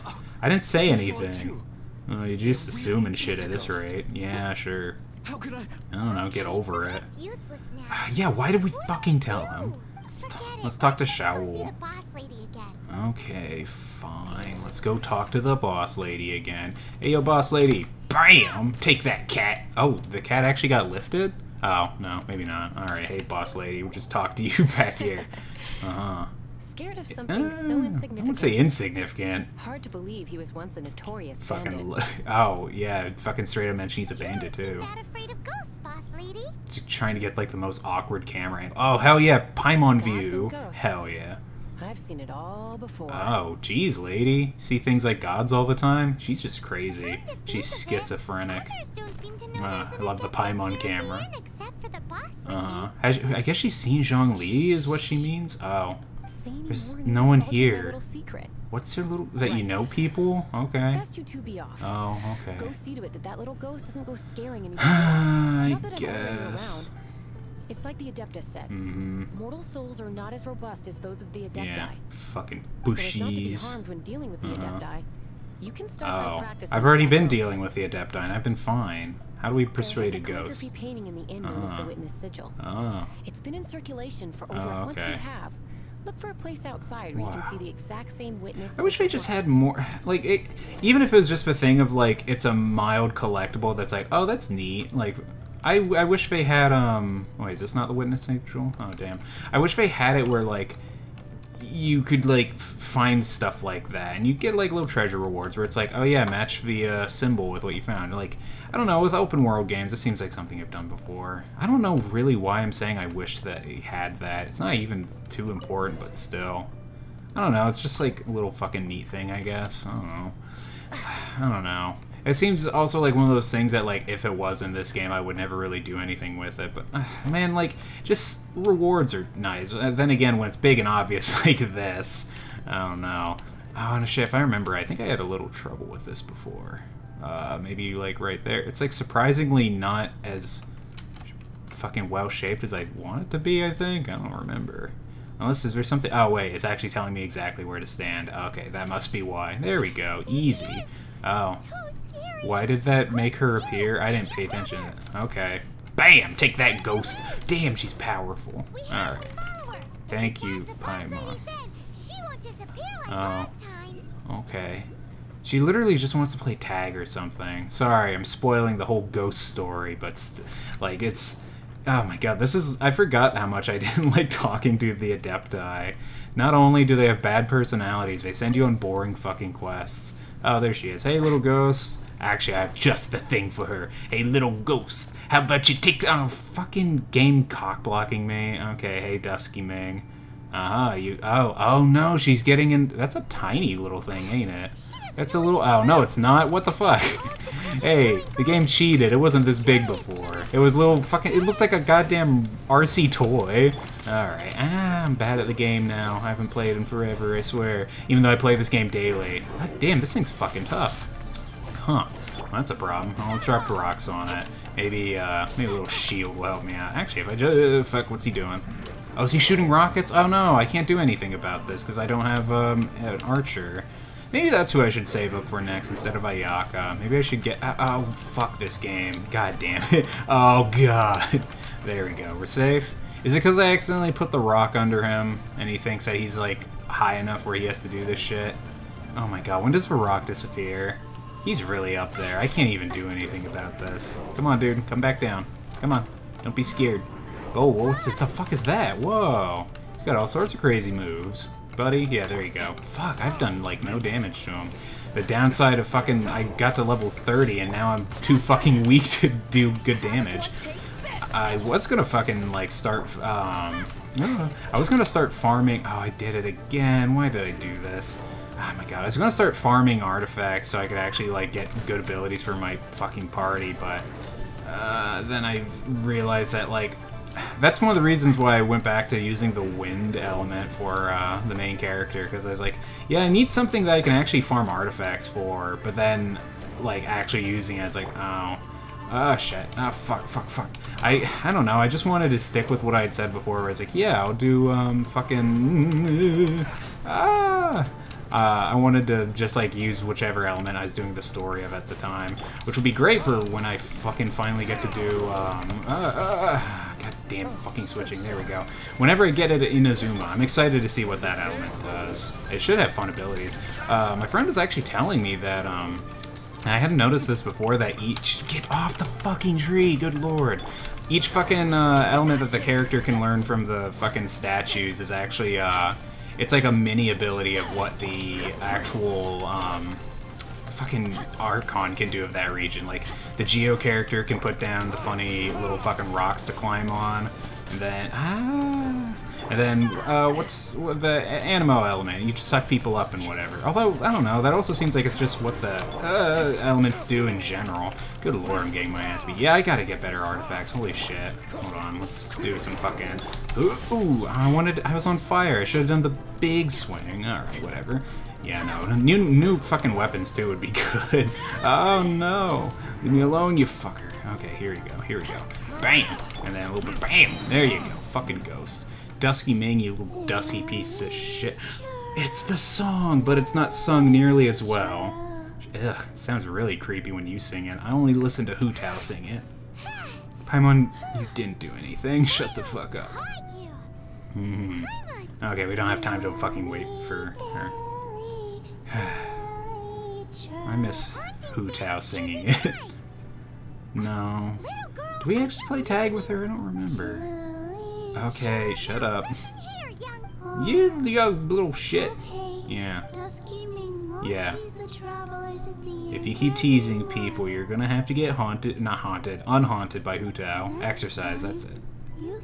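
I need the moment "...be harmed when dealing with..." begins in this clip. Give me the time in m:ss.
1:13.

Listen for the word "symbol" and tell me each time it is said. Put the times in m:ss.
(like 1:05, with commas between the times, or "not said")
1:47.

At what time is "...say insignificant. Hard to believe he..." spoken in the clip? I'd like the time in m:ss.
0:28.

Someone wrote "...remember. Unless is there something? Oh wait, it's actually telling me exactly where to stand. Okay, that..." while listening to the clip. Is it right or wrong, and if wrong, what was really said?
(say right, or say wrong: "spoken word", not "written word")
right.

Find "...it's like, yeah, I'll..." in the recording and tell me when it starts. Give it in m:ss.
4:53.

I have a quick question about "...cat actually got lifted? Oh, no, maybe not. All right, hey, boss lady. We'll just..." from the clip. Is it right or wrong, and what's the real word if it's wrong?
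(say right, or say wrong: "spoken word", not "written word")
right.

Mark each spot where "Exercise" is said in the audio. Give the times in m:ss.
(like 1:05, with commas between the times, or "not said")
6:50.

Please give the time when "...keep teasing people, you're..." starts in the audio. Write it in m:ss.
6:46.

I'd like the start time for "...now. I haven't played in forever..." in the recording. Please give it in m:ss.
3:25.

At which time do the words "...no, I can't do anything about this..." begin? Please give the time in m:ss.
3:40.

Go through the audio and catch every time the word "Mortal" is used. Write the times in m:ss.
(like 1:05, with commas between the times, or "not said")
1:09.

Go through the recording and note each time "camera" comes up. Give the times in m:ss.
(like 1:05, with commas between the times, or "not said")
0:38, 0:50.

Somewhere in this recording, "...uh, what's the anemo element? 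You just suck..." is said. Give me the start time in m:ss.
5:40.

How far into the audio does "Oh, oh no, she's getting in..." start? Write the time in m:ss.
3:11.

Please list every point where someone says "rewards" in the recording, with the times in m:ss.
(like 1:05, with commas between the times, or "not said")
1:45, 2:08.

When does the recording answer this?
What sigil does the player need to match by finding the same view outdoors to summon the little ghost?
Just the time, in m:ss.
1:21.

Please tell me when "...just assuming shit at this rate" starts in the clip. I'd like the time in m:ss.
0:02.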